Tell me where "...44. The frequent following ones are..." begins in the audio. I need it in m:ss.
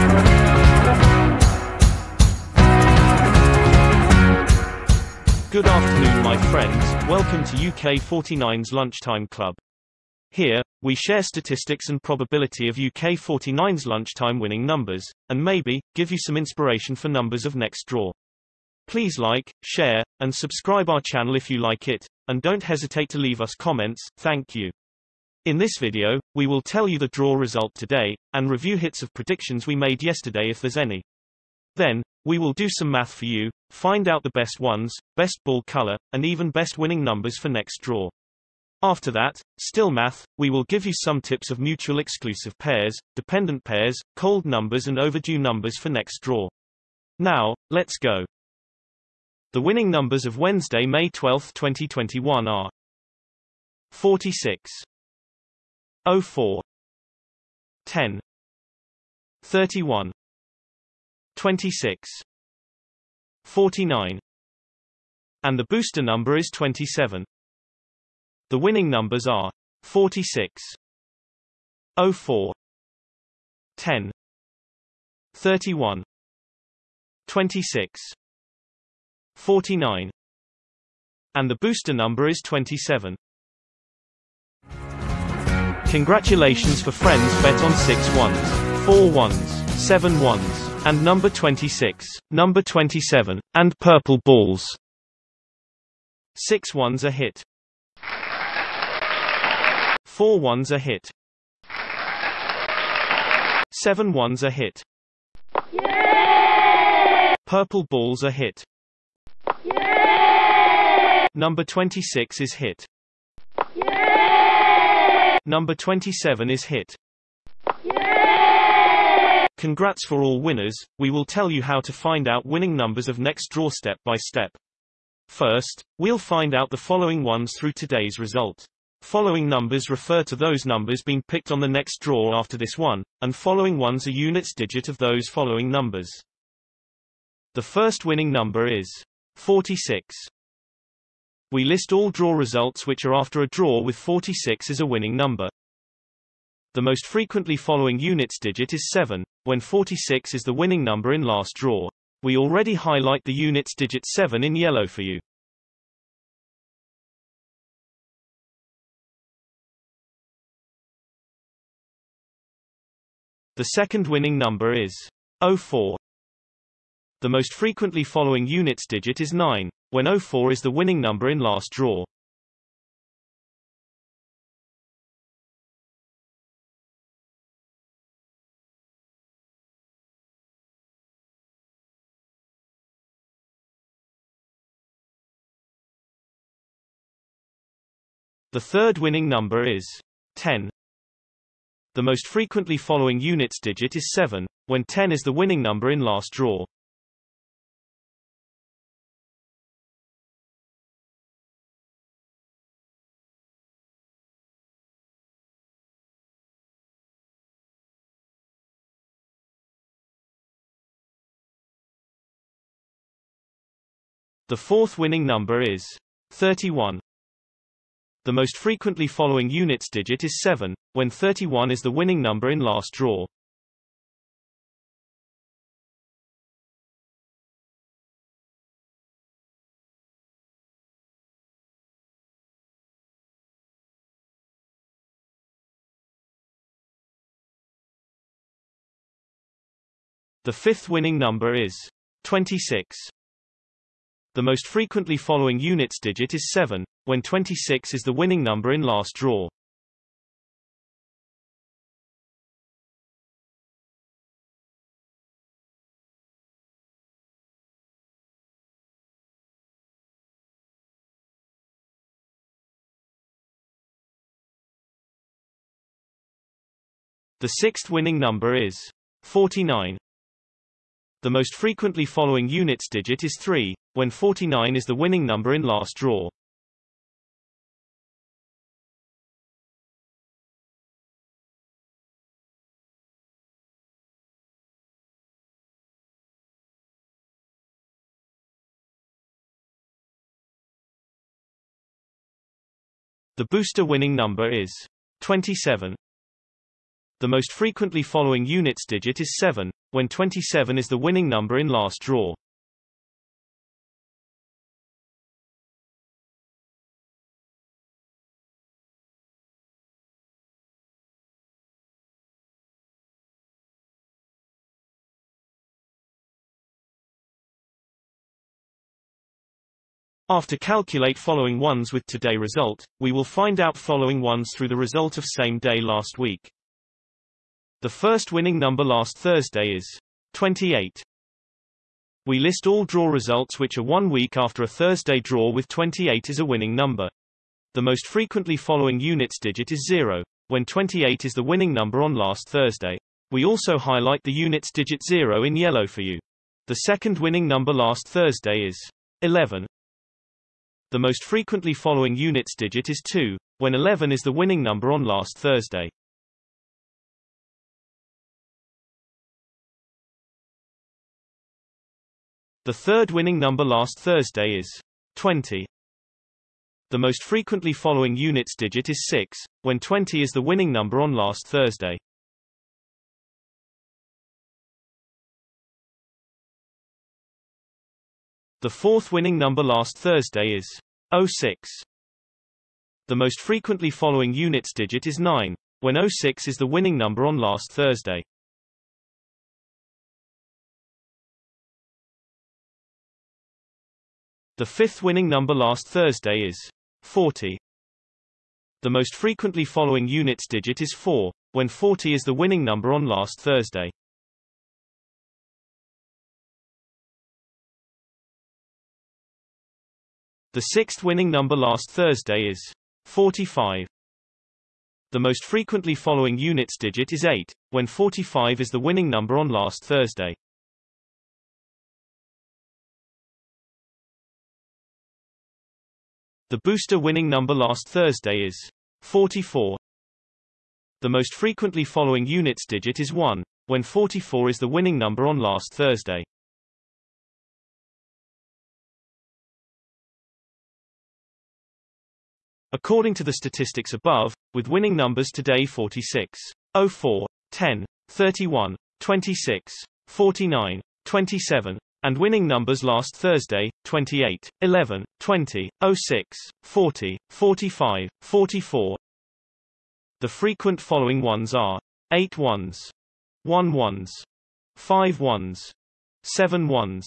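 7:38.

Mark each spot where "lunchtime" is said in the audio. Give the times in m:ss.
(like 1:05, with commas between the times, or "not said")
0:08, 0:13.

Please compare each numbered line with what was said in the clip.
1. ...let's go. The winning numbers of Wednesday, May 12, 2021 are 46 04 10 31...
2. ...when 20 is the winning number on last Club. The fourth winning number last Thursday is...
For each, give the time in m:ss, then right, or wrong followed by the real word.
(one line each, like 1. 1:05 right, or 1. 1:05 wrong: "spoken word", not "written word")
1. 0:47 right
2. 6:09 wrong: "Thursday", not "Club".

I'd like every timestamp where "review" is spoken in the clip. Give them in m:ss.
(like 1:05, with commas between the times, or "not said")
0:28.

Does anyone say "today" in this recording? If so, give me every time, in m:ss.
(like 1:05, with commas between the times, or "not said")
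0:27, 2:07, 5:22, 7:25.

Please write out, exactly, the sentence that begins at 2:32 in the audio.
We already highlight the units digit 7 in yellow for you.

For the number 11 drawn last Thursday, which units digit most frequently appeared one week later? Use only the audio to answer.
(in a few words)
2.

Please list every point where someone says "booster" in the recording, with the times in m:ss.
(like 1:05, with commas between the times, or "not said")
1:05, 1:21, 4:53, 7:06.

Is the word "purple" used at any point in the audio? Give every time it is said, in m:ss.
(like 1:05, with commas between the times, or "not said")
1:33, 1:47.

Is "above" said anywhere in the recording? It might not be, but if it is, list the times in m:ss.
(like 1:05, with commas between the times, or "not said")
7:23.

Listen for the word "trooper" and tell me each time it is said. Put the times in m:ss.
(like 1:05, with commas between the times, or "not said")
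not said.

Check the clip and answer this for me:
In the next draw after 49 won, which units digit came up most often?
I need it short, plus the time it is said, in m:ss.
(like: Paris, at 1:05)
3, at 4:33.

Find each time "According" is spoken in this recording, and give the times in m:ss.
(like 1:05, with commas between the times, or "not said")
7:22.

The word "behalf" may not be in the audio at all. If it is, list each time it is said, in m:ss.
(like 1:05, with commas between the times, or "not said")
not said.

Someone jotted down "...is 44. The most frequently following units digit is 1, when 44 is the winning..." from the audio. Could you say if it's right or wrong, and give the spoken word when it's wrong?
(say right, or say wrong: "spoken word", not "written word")
right.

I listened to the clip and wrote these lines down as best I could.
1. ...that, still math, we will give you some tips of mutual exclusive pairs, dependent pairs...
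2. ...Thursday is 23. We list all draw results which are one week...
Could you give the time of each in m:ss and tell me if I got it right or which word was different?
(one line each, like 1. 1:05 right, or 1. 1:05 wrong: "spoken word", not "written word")
1. 0:39 right
2. 5:29 wrong: "28", not "23".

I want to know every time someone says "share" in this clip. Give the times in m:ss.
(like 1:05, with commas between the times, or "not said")
0:10, 0:19.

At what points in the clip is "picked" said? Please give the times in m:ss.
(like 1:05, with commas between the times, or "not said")
2:11.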